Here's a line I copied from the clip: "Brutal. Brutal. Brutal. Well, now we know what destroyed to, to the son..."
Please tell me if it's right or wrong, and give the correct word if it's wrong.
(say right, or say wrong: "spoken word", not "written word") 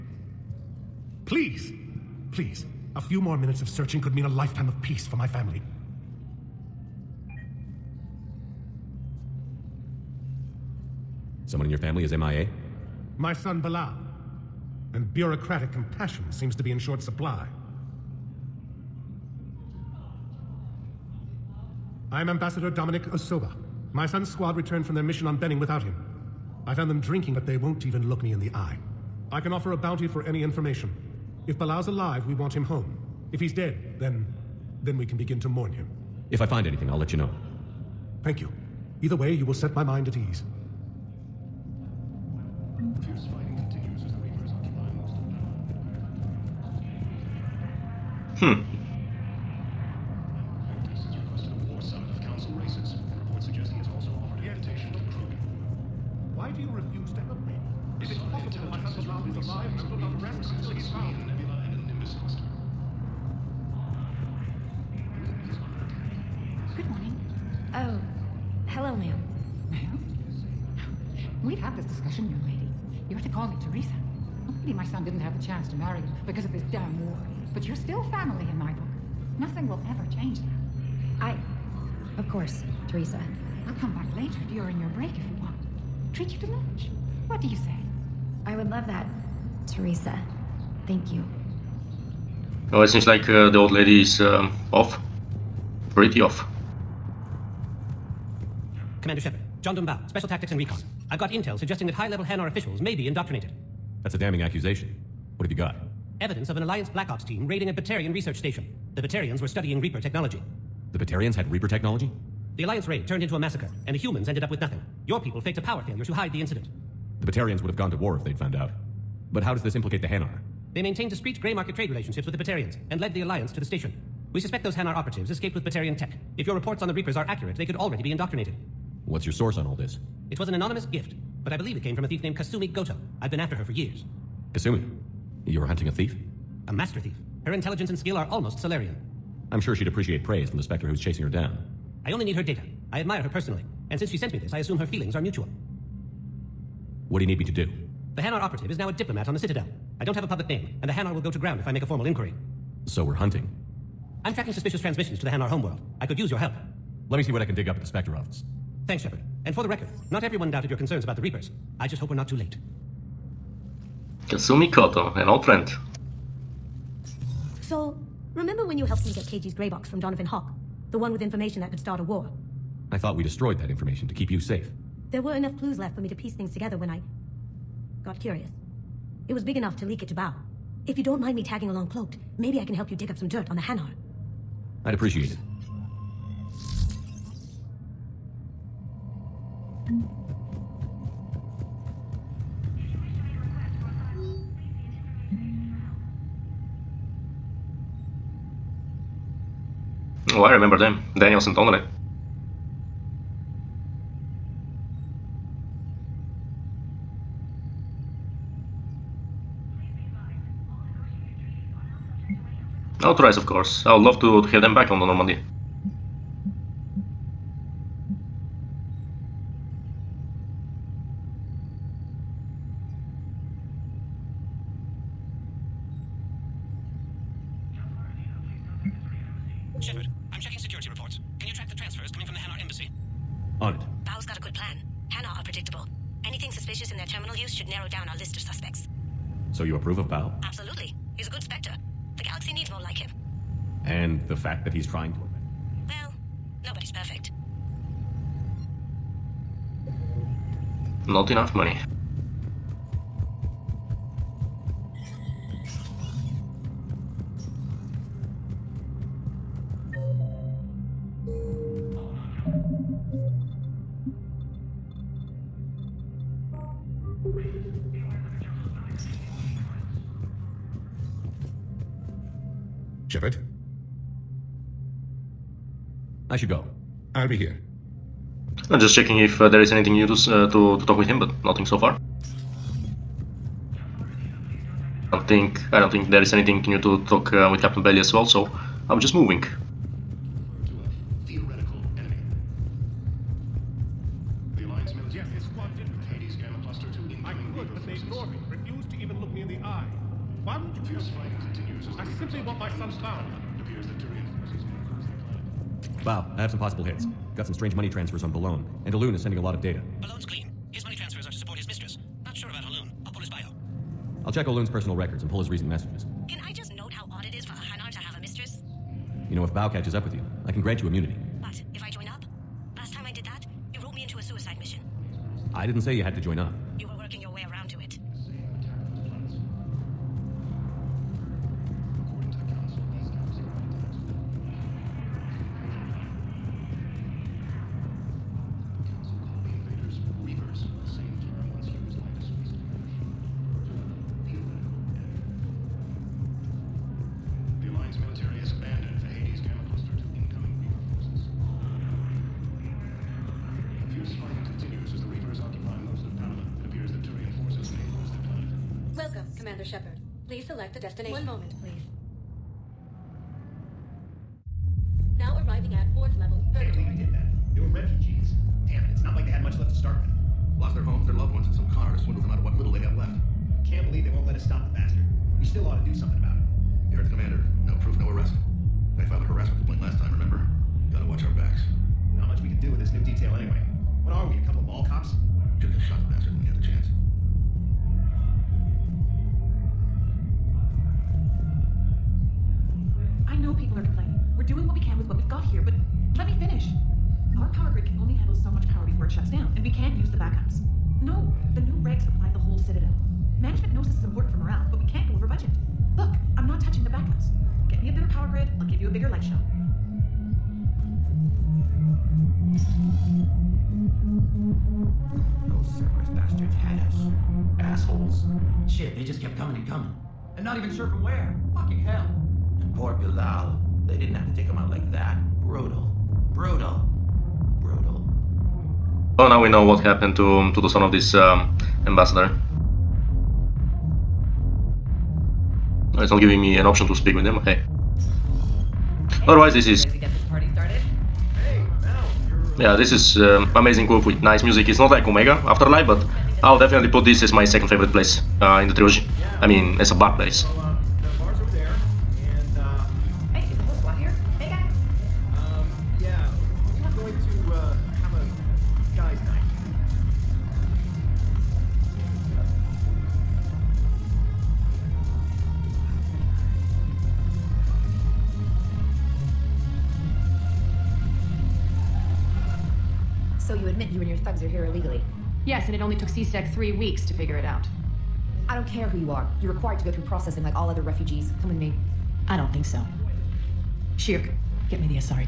wrong: "happened", not "destroyed".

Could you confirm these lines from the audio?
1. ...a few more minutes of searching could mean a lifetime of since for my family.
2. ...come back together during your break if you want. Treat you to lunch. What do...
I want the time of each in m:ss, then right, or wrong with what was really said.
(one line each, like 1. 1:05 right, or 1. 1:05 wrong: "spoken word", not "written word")
1. 0:02 wrong: "peace", not "since"
2. 1:23 wrong: "later", not "together".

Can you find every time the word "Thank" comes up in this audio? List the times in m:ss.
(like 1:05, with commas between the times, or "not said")
0:38, 1:30, 2:38.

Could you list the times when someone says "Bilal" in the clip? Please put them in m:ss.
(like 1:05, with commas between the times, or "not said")
0:13, 0:31, 7:02.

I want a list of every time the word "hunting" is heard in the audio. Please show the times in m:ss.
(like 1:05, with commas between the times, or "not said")
2:15, 2:33.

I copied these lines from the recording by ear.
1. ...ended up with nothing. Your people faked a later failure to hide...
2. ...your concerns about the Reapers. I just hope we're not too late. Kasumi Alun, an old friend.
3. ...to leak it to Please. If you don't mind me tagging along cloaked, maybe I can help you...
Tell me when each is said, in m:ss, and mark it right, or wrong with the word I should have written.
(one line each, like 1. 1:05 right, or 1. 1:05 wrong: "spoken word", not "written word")
1. 1:54 wrong: "power", not "later"
2. 2:40 wrong: "Goto", not "Alun"
3. 2:59 wrong: "Bau", not "Please".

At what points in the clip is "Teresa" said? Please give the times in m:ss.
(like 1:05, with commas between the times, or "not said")
1:22, 1:29.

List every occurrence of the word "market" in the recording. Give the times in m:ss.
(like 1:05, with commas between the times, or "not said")
2:01.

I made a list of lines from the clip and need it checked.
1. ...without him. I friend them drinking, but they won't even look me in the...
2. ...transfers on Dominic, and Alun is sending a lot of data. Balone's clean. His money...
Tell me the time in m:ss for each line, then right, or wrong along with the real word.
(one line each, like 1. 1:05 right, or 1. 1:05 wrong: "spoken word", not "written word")
1. 0:25 wrong: "found", not "friend"
2. 5:07 wrong: "Balone", not "Dominic".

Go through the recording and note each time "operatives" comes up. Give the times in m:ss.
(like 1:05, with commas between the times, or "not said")
2:04, 2:28.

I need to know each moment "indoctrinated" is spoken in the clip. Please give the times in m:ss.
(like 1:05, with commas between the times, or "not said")
1:43, 2:08.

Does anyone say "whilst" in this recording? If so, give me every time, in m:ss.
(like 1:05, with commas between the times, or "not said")
not said.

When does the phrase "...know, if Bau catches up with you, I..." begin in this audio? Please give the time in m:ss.
5:19.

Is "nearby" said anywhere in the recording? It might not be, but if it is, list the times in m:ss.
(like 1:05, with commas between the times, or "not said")
not said.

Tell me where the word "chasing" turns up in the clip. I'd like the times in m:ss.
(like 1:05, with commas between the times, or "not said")
2:20.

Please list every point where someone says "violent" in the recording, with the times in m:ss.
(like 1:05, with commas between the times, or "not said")
not said.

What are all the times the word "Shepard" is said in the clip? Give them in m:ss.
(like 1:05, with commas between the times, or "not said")
1:39, 2:39, 4:33.